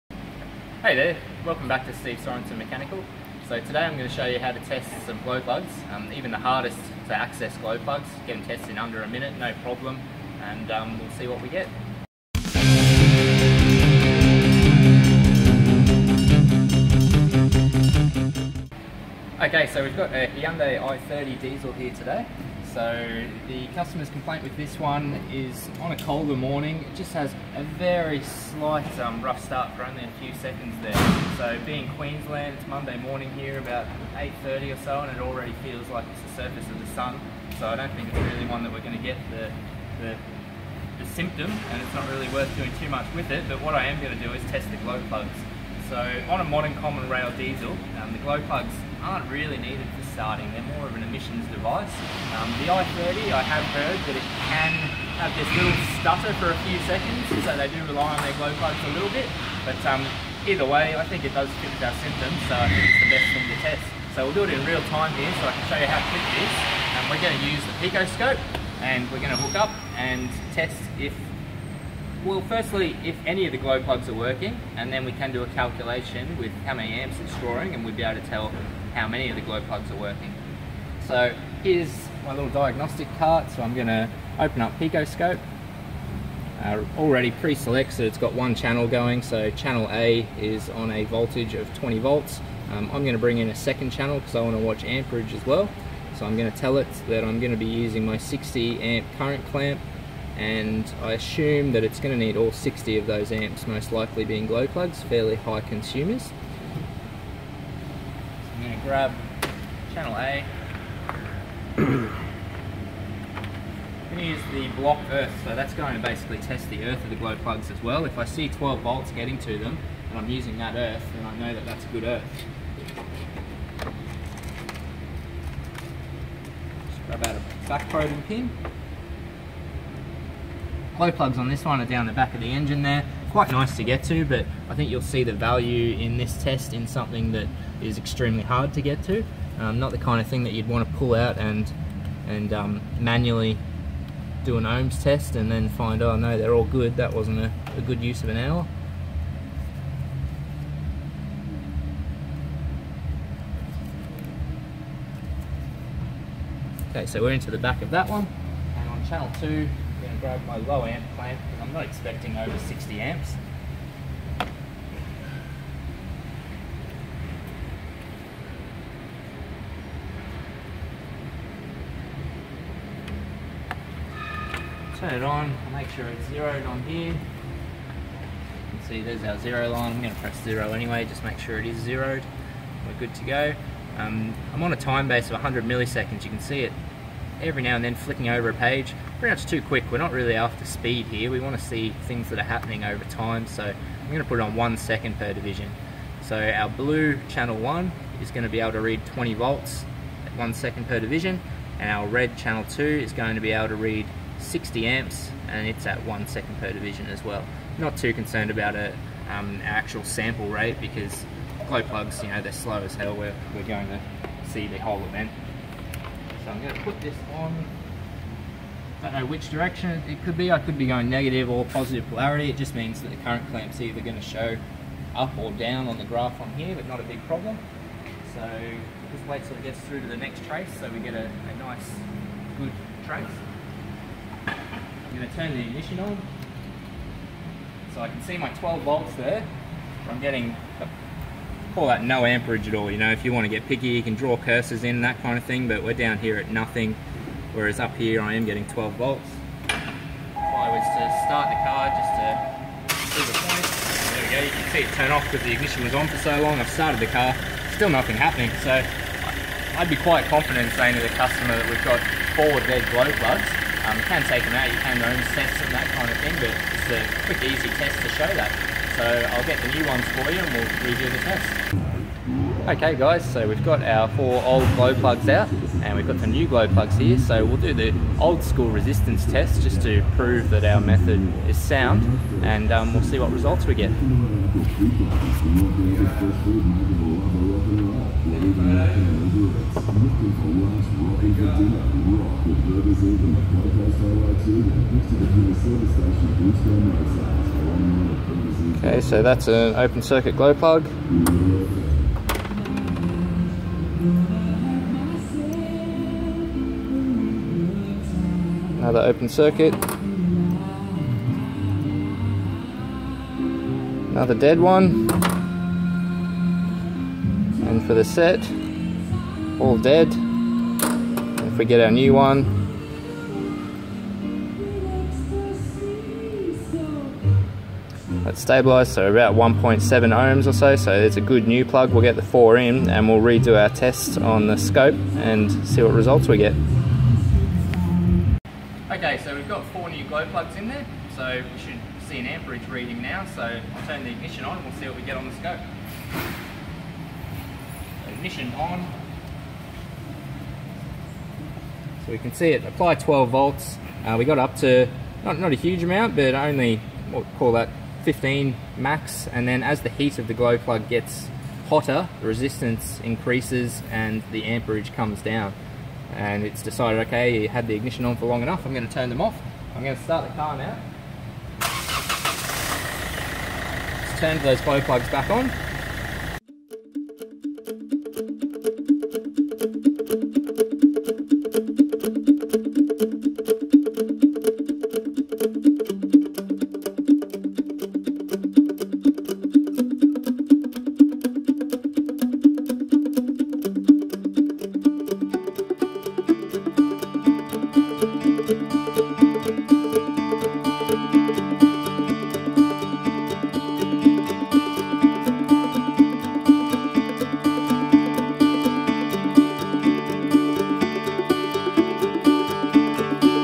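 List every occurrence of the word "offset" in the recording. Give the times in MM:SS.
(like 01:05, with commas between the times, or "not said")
not said.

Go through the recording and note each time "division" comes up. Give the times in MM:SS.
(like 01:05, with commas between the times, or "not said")
03:15, 03:20, 03:26.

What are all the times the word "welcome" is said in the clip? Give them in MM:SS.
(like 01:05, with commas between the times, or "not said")
00:01.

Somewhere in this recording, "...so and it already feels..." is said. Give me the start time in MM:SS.
00:34.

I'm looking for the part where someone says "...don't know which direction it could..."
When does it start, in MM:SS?
03:39.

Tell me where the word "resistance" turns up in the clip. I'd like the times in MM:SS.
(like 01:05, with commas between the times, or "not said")
04:38, 06:02.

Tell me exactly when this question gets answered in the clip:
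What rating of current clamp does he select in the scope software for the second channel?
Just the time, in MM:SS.
01:38.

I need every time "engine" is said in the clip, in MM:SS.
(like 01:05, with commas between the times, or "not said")
02:12.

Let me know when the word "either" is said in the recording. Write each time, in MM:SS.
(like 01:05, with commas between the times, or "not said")
01:00, 03:43.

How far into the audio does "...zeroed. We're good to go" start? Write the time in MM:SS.
03:01.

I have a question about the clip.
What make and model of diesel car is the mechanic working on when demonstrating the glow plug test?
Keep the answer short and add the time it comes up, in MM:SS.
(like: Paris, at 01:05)
Hyundai i30, at 00:20.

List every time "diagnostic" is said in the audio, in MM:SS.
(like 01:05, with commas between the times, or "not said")
01:22.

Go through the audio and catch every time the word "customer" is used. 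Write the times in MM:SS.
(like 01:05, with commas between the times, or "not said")
00:23, 04:21.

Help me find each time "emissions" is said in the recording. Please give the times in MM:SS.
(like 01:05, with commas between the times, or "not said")
00:51.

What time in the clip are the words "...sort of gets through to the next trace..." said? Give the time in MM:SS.
03:49.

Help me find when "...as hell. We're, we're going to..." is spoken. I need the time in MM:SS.
03:32.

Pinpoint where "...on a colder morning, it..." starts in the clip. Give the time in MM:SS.
00:25.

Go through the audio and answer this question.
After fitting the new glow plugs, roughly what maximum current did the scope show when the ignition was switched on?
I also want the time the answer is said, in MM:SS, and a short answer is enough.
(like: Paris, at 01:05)
15 amps, at 05:58.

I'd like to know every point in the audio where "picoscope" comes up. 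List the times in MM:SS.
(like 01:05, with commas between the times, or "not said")
01:07, 01:24.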